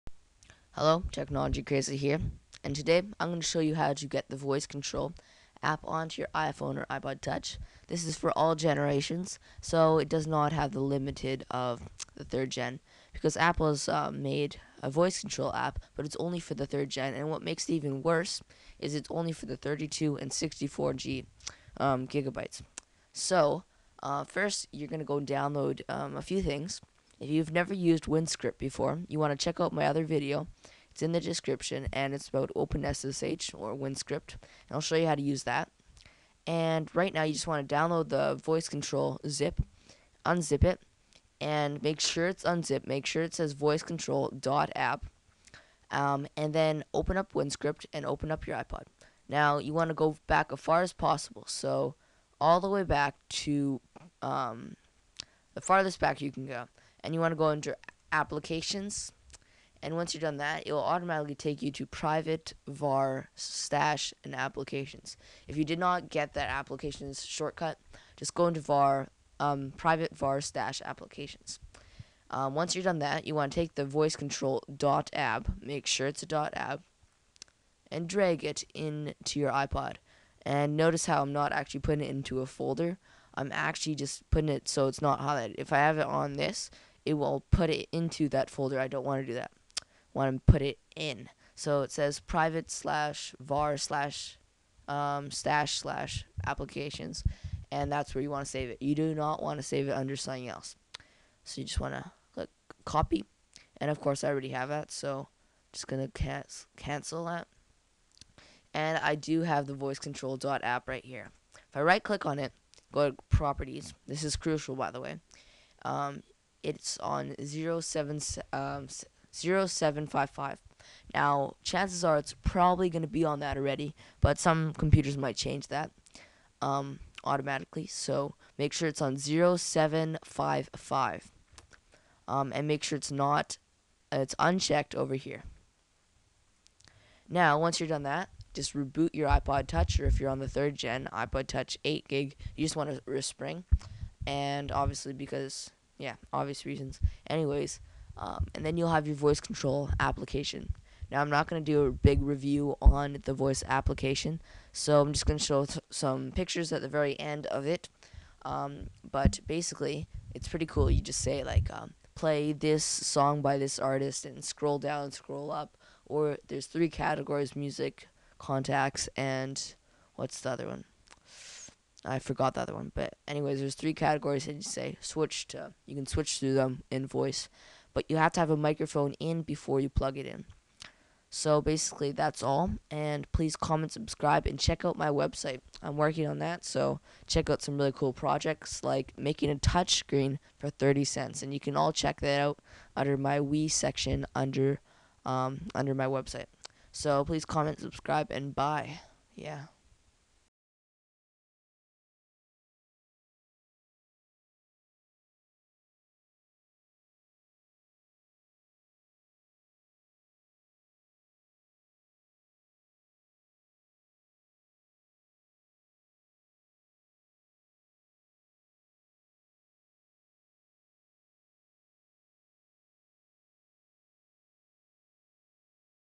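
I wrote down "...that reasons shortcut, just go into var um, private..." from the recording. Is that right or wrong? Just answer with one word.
wrong.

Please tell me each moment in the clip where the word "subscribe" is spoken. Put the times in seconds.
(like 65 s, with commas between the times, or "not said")
183 s, 197 s.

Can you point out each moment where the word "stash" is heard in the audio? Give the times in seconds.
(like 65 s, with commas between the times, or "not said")
63 s, 70 s, 95 s.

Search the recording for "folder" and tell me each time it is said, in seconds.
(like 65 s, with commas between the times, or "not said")
82 s, 88 s.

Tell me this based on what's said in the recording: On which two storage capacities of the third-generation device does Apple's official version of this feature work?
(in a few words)
32 and 64 GB.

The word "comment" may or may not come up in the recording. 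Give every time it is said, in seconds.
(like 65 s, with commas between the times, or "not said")
183 s, 197 s.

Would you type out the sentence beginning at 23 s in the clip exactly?
So, uh, first, you're going to go download um, a few things.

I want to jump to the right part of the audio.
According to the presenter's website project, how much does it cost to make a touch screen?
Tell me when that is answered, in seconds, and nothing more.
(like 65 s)
190 s.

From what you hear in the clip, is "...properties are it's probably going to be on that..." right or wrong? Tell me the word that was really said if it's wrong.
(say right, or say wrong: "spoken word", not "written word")
wrong: "chances", not "properties".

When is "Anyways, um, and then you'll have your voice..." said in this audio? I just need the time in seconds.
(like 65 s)
147 s.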